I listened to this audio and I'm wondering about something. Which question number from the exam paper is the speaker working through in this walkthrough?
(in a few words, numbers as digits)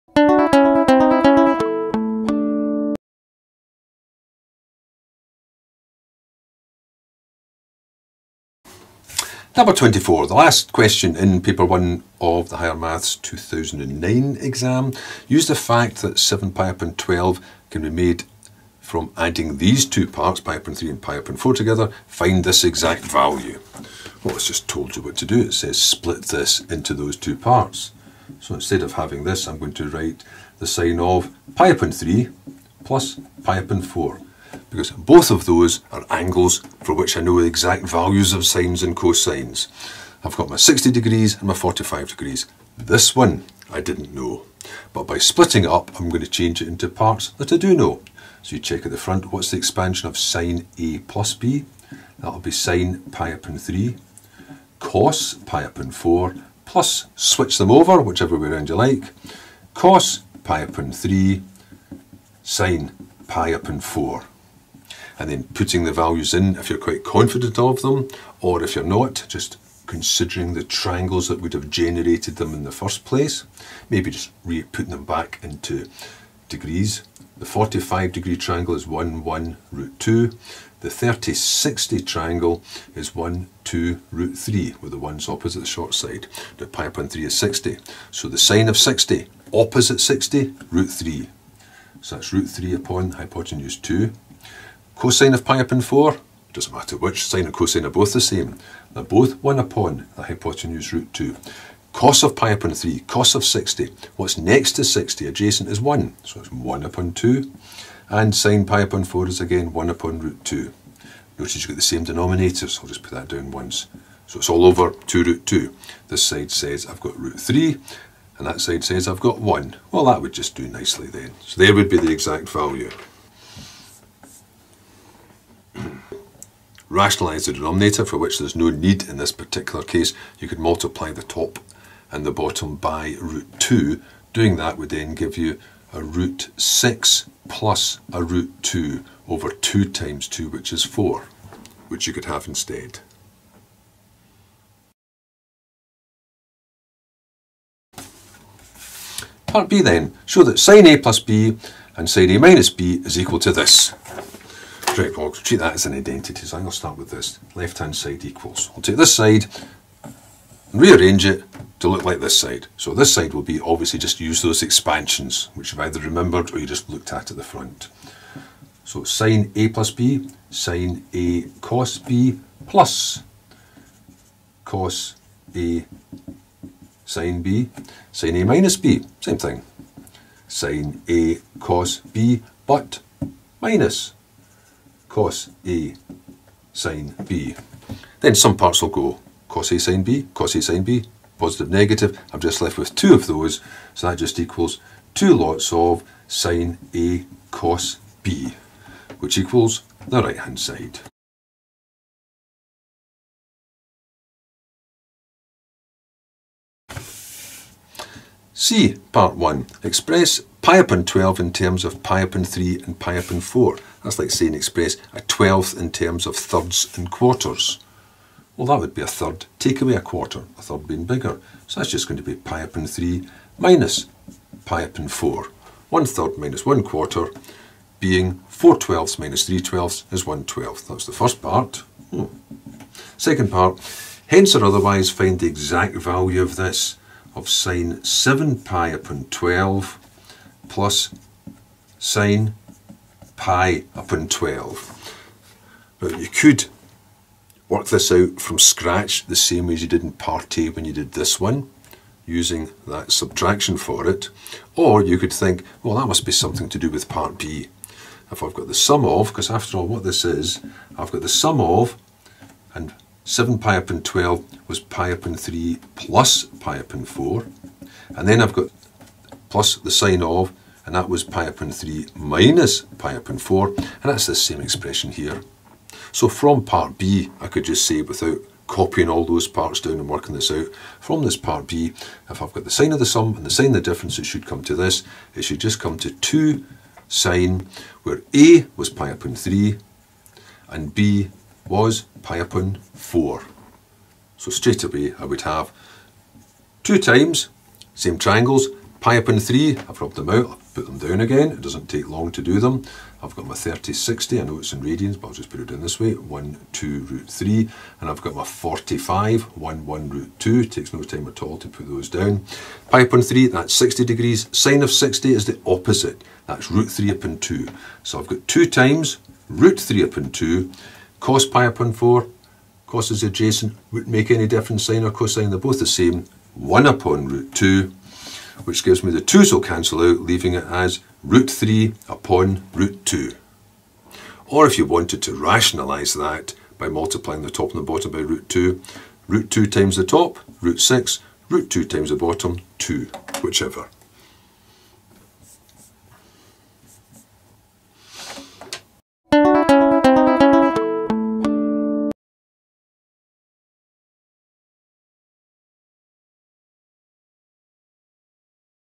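24.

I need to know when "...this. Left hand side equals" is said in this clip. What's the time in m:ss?
2:37.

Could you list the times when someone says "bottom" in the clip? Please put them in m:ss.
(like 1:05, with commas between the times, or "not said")
2:12, 5:37, 5:42.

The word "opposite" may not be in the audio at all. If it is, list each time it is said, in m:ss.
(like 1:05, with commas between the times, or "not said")
1:25, 1:29, 5:15.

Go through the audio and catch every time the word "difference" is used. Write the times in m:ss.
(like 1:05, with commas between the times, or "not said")
4:43, 5:24.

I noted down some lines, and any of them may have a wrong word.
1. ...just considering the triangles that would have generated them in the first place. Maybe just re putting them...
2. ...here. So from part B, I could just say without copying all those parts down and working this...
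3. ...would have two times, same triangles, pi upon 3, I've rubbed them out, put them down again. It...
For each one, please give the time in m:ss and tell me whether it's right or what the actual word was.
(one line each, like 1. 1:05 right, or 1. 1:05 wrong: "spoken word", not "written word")
1. 1:09 right
2. 4:35 right
3. 4:55 right.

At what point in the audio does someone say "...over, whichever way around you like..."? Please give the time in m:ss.
0:57.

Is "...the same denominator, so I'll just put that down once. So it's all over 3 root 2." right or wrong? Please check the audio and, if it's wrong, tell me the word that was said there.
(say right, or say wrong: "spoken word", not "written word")
wrong: "2", not "3".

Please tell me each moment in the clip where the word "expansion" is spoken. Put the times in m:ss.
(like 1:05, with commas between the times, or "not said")
0:49, 2:44.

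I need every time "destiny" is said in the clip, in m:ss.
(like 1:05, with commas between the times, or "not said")
not said.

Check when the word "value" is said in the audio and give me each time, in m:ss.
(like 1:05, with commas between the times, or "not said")
0:23, 0:37, 1:05, 2:02, 3:55.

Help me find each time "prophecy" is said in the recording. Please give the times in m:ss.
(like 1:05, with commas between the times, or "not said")
not said.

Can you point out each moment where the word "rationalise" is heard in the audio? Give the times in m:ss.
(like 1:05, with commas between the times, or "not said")
2:06, 5:35.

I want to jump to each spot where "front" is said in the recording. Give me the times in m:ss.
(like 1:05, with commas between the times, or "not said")
0:48, 2:47.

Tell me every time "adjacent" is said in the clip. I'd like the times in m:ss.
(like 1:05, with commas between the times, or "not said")
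1:45, 5:23.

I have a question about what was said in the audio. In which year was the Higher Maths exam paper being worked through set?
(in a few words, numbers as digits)
2009.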